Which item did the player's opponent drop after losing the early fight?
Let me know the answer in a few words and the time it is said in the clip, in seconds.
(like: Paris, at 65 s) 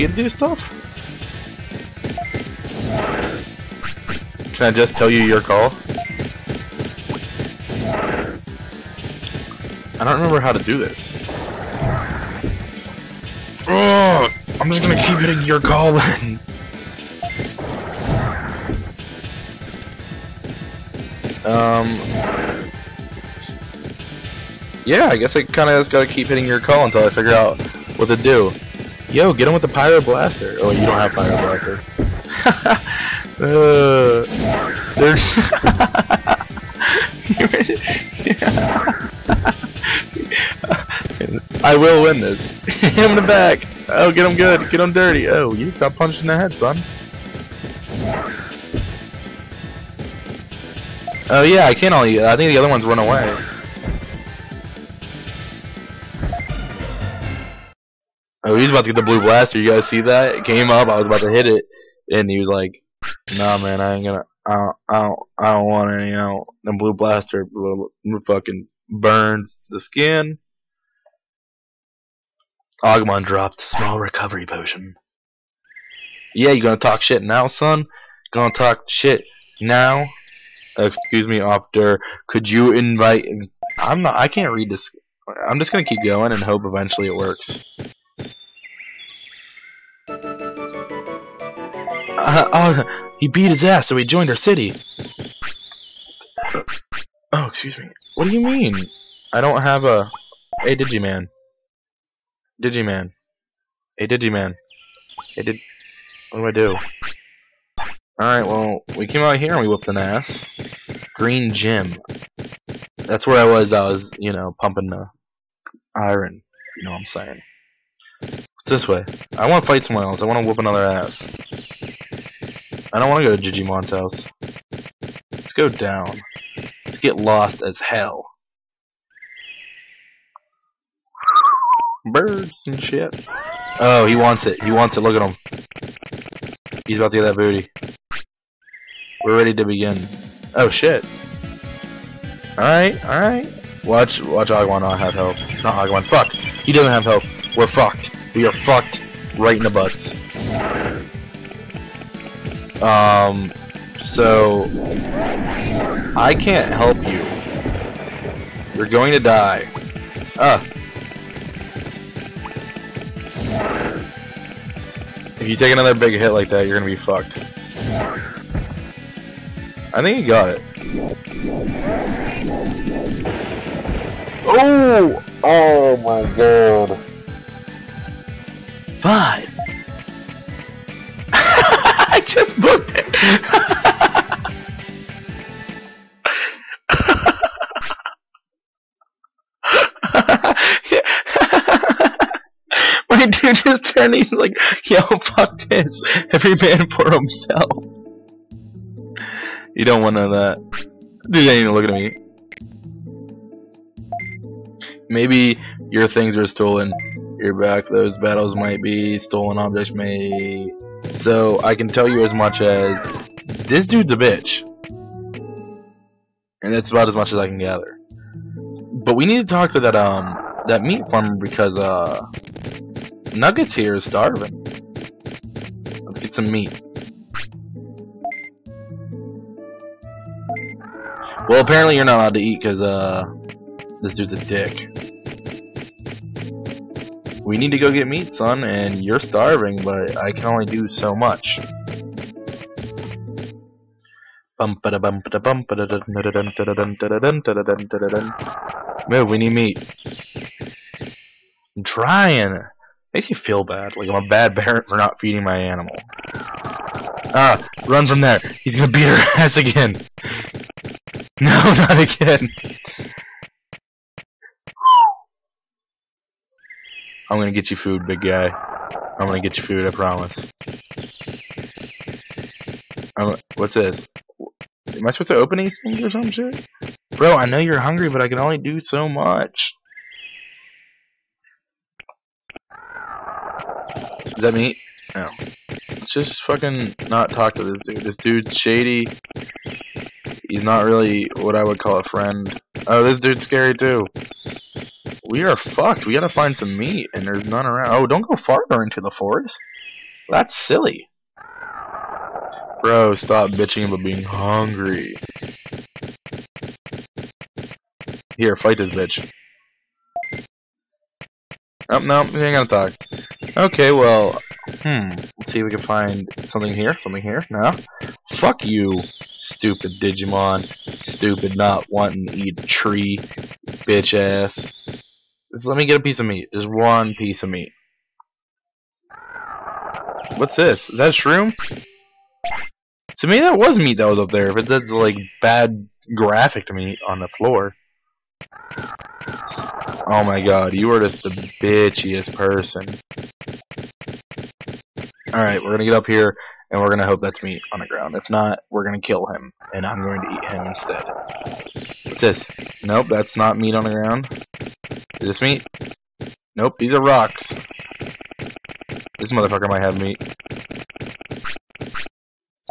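small recovery potion, at 73 s.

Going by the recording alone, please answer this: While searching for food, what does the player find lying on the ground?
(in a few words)
rocks.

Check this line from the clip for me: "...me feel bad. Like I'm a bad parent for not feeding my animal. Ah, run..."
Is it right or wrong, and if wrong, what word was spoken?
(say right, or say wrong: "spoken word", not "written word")
right.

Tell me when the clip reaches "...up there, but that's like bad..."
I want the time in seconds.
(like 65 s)
334 s.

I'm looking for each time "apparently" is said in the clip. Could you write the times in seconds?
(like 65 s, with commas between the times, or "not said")
231 s.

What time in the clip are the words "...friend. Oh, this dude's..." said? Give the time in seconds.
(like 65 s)
292 s.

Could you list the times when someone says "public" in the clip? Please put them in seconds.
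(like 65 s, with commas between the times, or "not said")
not said.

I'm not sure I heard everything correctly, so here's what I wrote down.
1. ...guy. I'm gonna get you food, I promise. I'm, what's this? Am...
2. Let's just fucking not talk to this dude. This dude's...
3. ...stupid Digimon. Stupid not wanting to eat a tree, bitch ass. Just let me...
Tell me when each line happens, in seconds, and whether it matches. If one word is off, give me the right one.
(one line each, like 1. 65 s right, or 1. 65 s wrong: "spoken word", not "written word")
1. 268 s right
2. 285 s right
3. 319 s right.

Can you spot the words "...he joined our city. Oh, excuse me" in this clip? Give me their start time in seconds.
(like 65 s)
93 s.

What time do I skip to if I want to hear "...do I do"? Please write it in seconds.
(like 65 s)
106 s.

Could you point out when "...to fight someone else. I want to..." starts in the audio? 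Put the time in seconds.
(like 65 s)
119 s.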